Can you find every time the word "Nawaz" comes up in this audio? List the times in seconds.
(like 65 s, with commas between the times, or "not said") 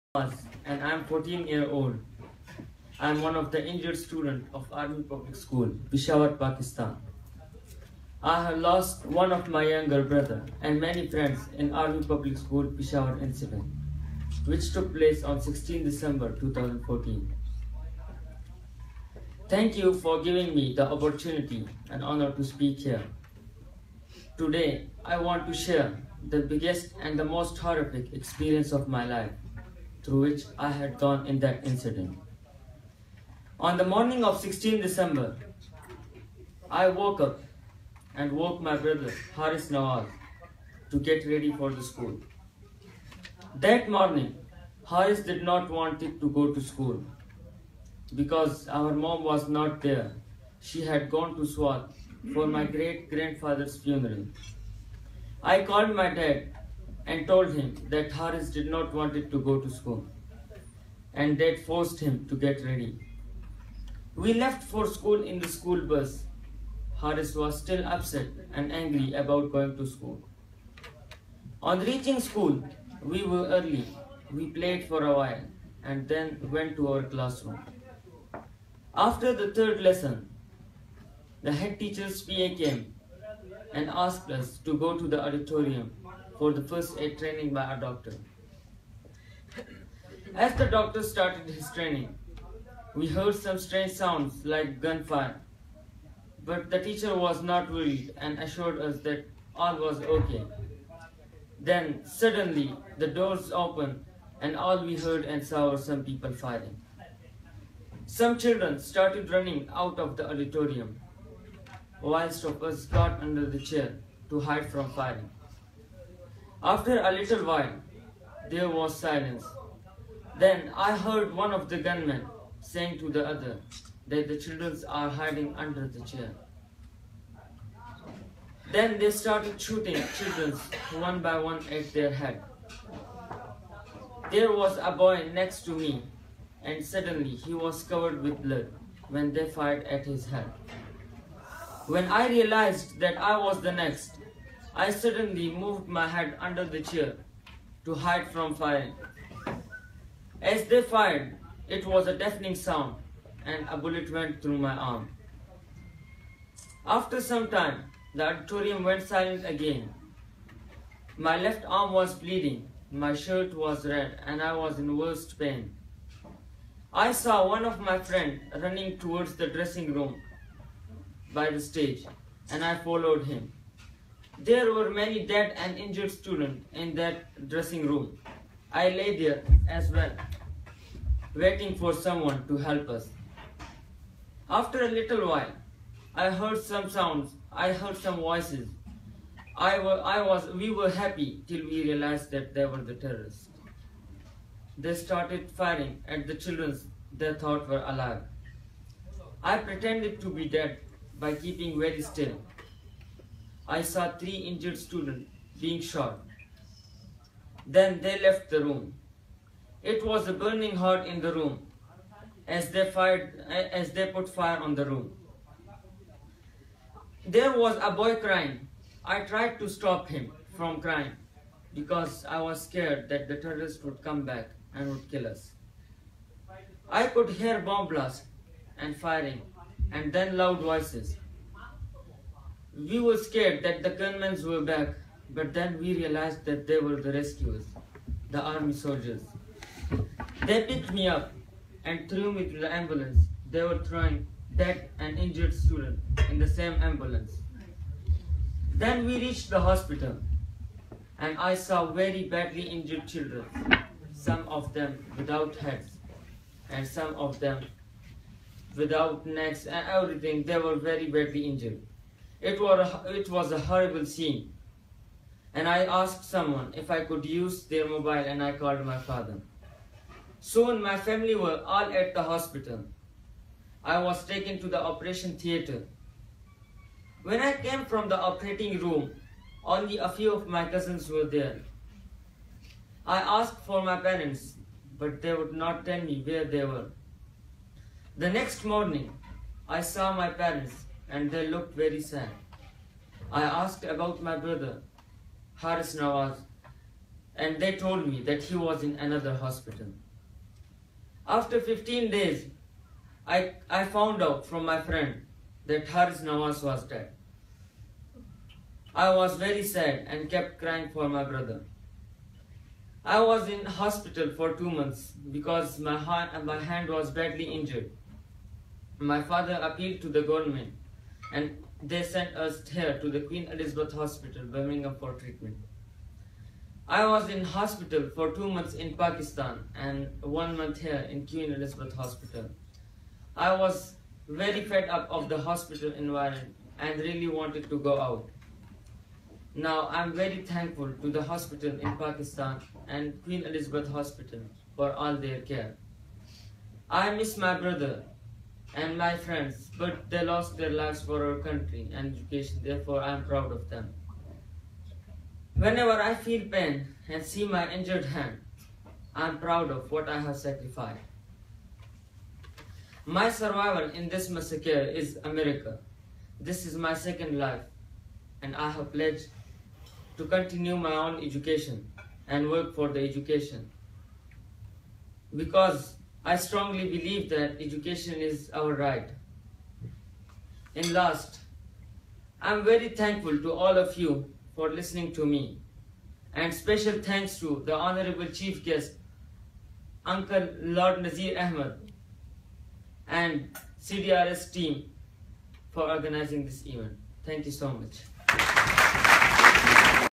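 39 s, 295 s, 306 s.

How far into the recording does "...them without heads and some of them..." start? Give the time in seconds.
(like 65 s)
254 s.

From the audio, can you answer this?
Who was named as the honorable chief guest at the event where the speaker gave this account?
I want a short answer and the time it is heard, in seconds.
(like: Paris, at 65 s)
Lord Nazir Ahmed, at 390 s.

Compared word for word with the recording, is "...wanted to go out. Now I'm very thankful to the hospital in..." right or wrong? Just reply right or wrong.
right.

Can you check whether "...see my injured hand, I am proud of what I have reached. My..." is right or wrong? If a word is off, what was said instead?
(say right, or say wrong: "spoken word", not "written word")
wrong: "sacrificed", not "reached".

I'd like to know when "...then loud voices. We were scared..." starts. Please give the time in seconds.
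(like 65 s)
230 s.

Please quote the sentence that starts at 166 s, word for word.
I saw one of my friends running towards the dressing room by the stage, and I followed him.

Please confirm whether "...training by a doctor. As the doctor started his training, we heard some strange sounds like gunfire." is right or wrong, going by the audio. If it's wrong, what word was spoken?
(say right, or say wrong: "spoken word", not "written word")
right.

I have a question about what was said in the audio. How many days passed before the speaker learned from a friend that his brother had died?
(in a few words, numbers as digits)
15.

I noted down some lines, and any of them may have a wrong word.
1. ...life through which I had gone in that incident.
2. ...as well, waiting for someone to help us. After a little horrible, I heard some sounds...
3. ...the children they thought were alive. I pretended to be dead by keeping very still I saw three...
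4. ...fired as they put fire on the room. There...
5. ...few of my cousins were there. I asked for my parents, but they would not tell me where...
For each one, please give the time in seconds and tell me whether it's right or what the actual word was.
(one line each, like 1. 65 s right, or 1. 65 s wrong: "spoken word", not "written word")
1. 29 s right
2. 179 s wrong: "while", not "horrible"
3. 196 s right
4. 212 s right
5. 280 s right.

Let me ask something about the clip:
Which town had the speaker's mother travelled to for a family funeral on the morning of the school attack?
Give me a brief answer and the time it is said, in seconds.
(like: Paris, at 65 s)
Swat, at 51 s.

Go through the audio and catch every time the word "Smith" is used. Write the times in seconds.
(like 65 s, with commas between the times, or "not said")
not said.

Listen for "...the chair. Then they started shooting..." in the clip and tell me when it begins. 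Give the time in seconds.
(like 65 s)
125 s.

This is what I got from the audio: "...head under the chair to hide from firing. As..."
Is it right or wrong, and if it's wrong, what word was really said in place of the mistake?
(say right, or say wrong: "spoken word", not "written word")
right.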